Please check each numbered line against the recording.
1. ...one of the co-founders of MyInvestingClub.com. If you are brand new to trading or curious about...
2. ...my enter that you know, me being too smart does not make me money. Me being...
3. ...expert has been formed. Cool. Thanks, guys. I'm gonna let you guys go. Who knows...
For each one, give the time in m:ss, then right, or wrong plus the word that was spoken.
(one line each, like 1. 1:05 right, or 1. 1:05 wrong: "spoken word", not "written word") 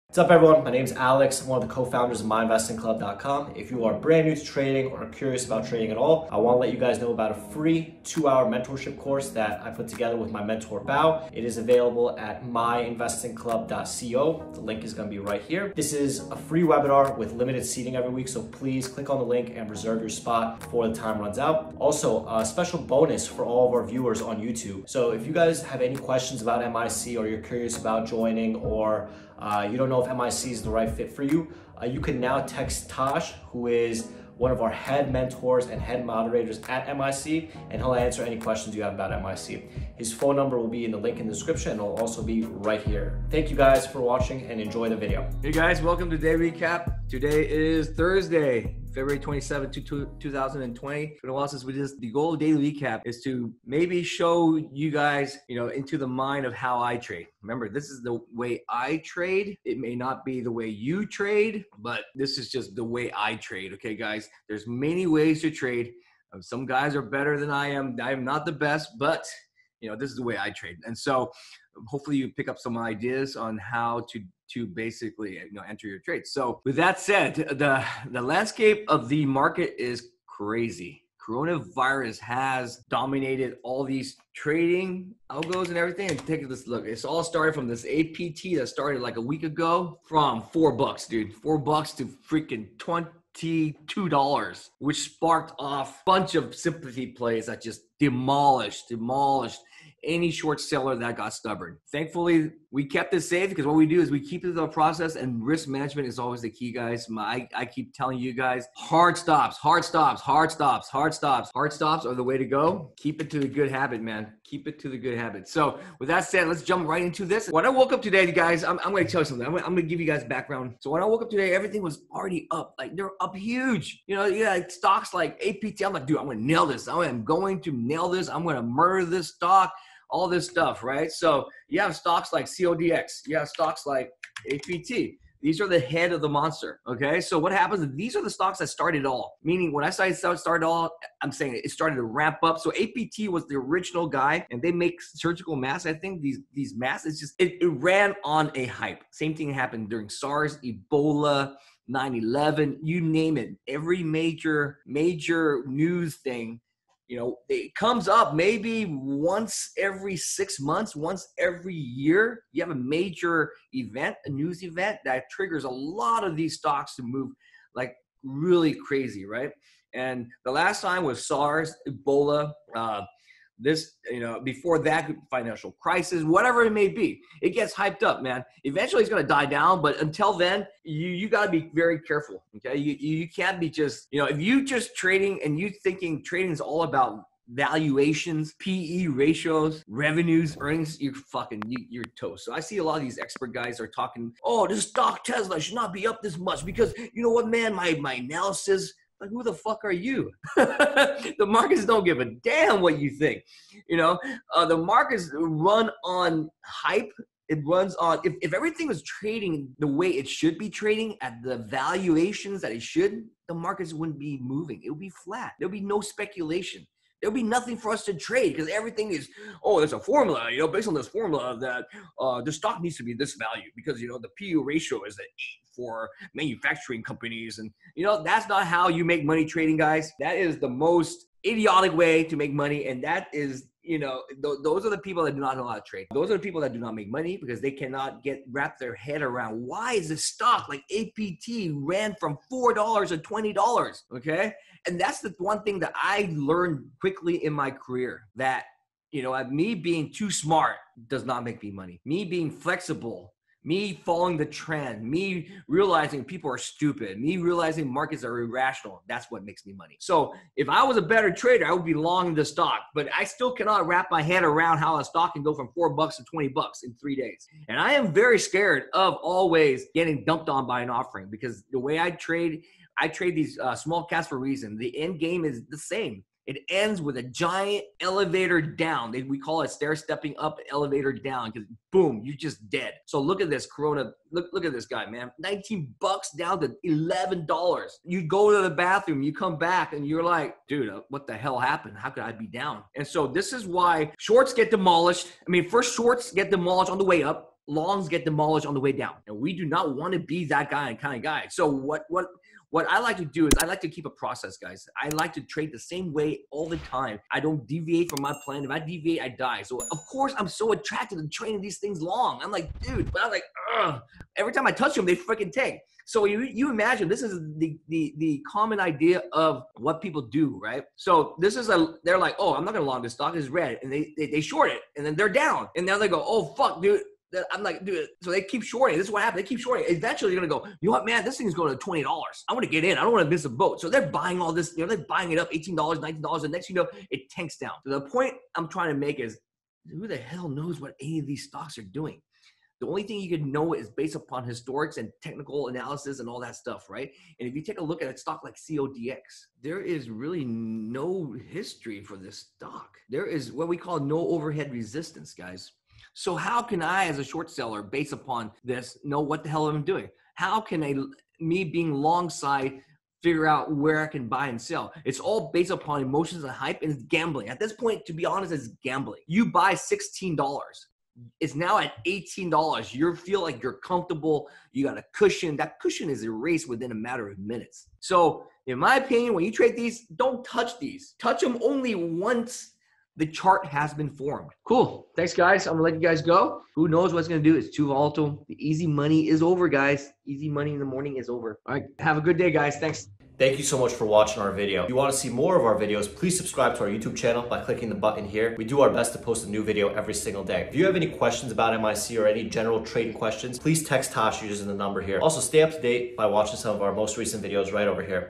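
1. 0:01 right
2. 4:07 wrong: "career", not "enter"
3. 6:23 wrong: "chart", not "expert".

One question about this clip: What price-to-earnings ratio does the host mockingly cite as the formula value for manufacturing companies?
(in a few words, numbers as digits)
8.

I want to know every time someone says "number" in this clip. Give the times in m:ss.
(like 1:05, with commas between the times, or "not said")
0:40, 6:44.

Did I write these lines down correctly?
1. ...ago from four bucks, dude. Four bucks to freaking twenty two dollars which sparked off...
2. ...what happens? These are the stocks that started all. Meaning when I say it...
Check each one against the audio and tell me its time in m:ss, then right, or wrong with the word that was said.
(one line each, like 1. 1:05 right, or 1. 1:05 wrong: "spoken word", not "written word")
1. 1:29 right
2. 2:17 right.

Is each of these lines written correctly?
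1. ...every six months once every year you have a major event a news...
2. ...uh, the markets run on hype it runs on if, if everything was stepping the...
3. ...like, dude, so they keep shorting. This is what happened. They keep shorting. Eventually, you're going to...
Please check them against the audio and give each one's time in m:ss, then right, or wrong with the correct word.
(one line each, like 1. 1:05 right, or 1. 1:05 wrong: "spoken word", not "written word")
1. 2:39 right
2. 3:24 wrong: "trading", not "stepping"
3. 5:27 right.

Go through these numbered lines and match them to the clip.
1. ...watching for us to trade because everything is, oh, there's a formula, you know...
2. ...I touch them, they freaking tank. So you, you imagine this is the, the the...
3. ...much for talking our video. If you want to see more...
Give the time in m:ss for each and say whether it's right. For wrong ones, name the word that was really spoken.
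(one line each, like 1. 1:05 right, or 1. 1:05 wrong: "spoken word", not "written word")
1. 3:37 wrong: "nothing", not "watching"
2. 5:14 right
3. 6:33 wrong: "watching", not "talking".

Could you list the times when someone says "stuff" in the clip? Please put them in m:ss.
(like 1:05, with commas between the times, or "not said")
2:10, 5:46.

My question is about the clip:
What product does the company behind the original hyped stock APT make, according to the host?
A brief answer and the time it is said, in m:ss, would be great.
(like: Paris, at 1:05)
Surgical masks, at 2:25.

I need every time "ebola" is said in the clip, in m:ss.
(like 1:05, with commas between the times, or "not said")
2:30, 2:51.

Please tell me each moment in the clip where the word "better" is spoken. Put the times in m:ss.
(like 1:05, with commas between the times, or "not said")
1:07, 4:21.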